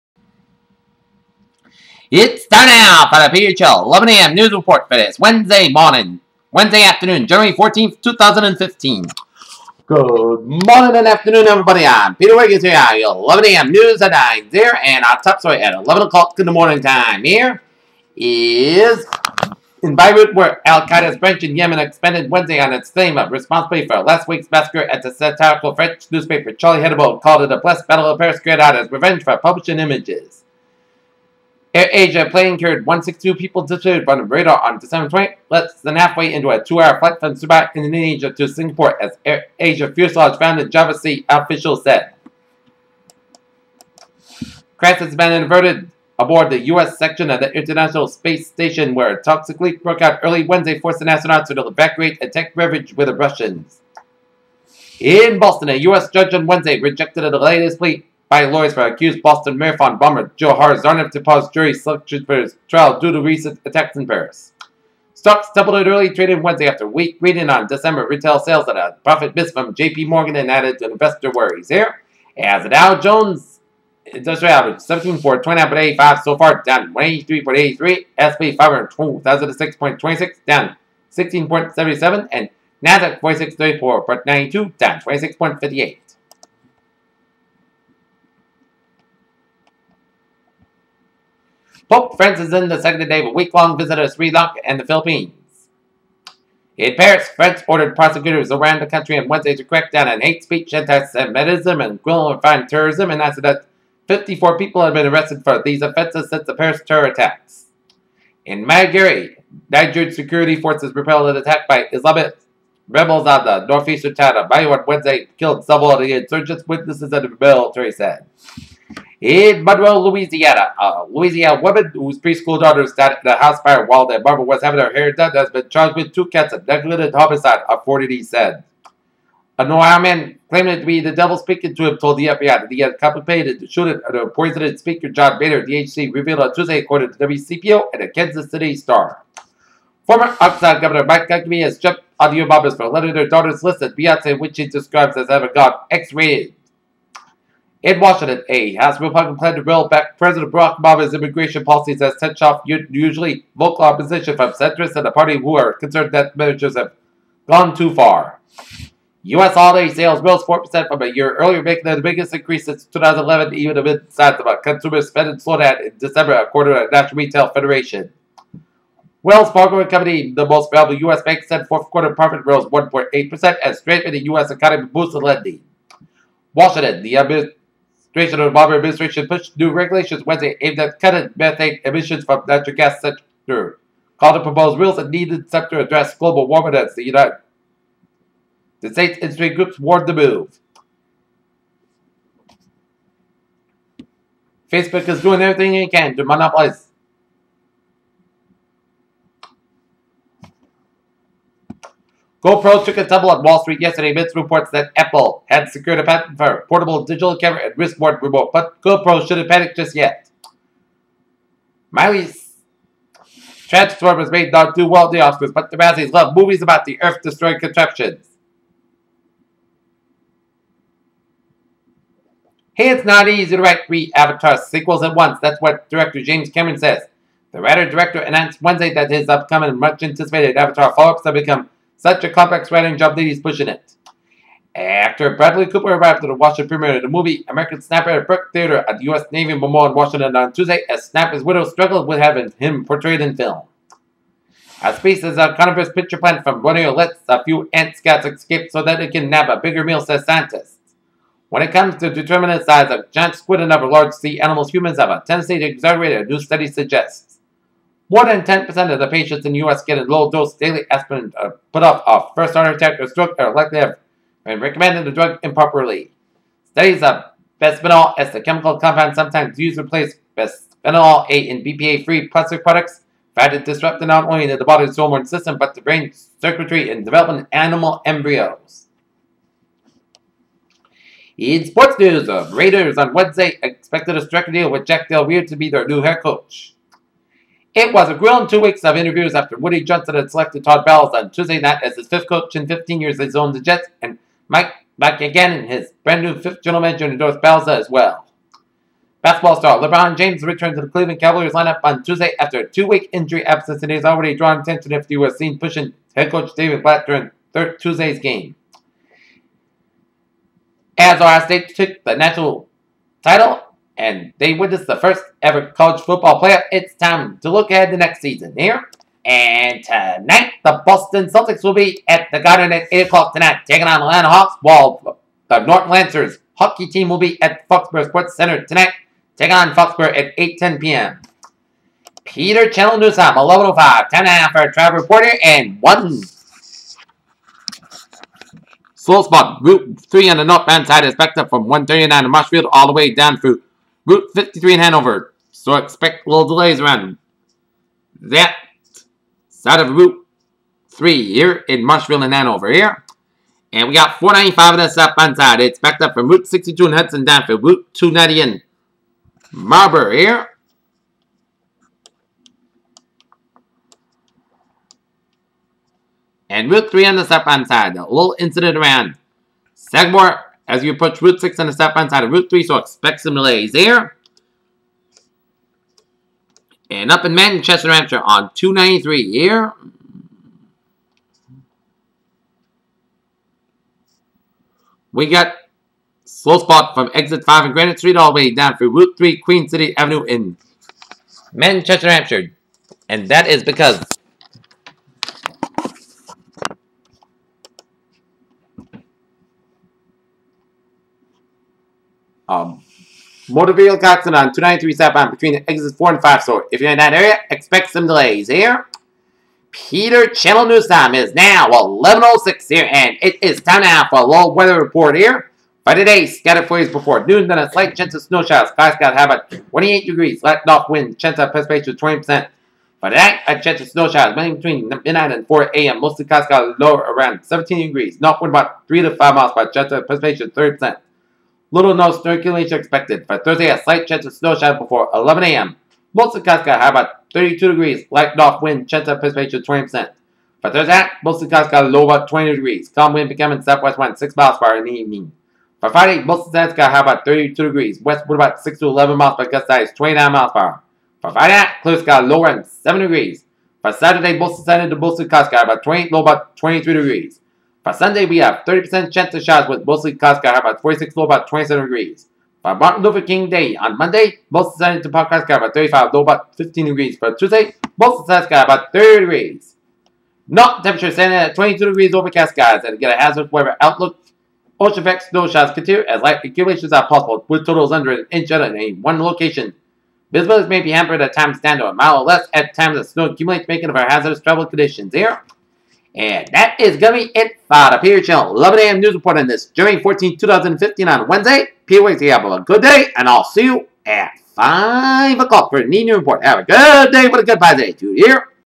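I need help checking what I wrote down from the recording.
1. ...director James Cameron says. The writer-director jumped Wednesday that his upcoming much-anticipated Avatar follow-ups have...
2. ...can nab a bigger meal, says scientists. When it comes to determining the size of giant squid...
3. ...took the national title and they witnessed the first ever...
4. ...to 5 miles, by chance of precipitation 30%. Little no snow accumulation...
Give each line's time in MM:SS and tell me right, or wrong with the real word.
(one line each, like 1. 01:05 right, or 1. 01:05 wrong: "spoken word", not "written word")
1. 03:45 wrong: "announced", not "jumped"
2. 04:09 right
3. 05:11 right
4. 07:09 right.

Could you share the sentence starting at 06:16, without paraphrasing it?
And up in Manchester, Hampshire on 293 here.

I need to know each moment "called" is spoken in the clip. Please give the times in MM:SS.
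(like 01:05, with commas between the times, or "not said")
00:27, 03:04.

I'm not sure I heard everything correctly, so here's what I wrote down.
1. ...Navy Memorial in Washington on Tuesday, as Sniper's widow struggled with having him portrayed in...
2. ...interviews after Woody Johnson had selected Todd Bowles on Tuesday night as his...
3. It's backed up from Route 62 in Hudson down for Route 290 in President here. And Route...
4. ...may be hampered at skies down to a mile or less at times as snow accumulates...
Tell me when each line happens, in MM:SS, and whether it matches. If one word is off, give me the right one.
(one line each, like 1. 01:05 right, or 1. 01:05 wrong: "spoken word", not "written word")
1. 03:59 right
2. 04:48 right
3. 05:55 wrong: "Marlborough", not "President"
4. 08:00 wrong: "times", not "skies".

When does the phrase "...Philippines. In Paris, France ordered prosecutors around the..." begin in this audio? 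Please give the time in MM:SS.
01:34.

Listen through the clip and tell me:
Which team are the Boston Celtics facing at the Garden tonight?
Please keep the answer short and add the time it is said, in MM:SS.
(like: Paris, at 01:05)
Atlanta Hawks, at 05:24.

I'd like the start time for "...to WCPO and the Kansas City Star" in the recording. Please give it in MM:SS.
02:17.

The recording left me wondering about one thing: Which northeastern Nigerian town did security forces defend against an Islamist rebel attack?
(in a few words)
Biu.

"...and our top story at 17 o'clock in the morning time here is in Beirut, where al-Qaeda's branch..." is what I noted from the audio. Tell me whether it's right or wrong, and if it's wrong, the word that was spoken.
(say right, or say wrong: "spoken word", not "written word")
wrong: "11", not "17".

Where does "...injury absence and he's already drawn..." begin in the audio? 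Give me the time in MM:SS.
05:03.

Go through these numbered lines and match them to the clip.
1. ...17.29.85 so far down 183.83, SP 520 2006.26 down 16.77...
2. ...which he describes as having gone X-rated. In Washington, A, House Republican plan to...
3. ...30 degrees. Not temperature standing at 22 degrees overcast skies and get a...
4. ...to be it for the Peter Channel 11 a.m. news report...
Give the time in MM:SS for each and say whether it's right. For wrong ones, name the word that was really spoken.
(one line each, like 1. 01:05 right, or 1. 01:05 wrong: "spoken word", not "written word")
1. 01:14 wrong: "500", not "520"
2. 02:24 right
3. 07:48 right
4. 08:07 right.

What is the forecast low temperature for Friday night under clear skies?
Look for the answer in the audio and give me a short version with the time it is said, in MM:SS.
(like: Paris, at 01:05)
7 degrees, at 07:32.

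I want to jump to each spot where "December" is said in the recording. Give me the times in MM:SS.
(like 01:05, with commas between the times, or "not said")
00:34, 01:07, 02:45.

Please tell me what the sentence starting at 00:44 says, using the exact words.
Crash has been inverted aboard the U.S.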